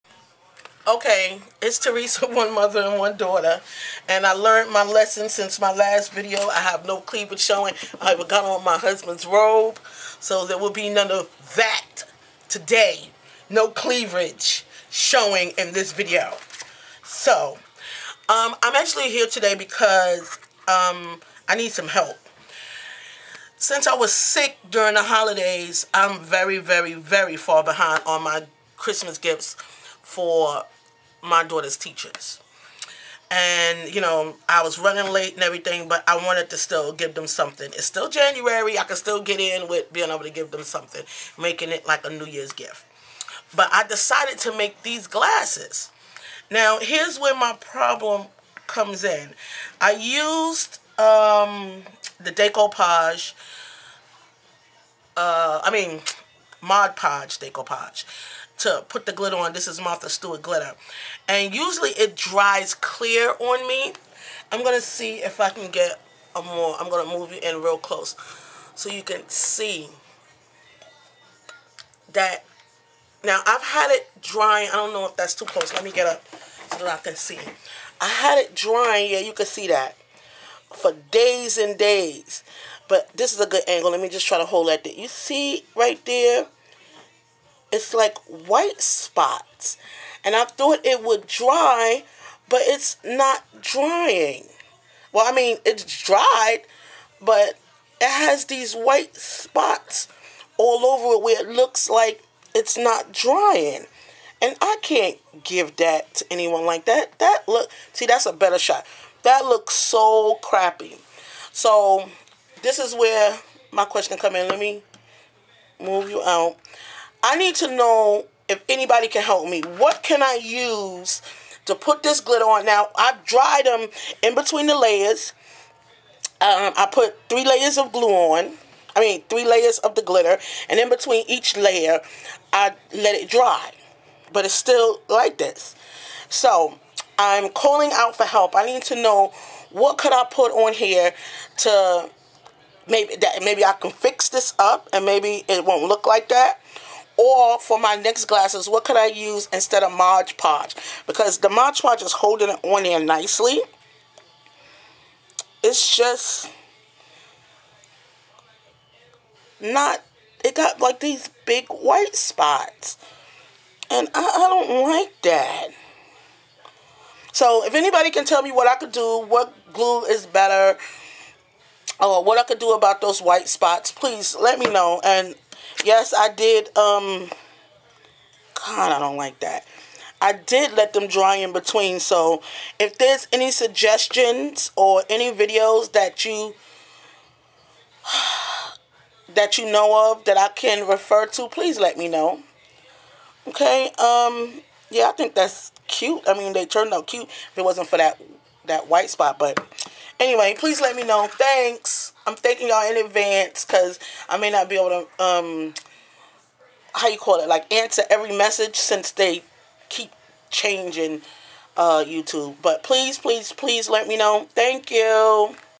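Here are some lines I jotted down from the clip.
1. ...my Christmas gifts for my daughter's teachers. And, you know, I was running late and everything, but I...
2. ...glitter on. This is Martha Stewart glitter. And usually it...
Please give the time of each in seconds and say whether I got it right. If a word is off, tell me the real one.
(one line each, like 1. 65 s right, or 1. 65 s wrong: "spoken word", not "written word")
1. 28 s right
2. 59 s right.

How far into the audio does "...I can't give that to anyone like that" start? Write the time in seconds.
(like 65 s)
104 s.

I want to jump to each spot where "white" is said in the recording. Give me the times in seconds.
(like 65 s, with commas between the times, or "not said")
88 s, 98 s, 161 s, 173 s, 198 s.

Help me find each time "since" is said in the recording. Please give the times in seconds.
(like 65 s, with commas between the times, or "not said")
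5 s, 23 s, 208 s.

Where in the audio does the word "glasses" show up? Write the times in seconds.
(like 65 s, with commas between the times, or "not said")
45 s, 148 s.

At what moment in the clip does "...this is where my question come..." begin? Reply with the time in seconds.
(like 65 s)
112 s.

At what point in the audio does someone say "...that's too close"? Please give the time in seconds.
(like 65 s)
75 s.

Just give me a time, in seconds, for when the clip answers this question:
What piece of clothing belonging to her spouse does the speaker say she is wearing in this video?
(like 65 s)
9 s.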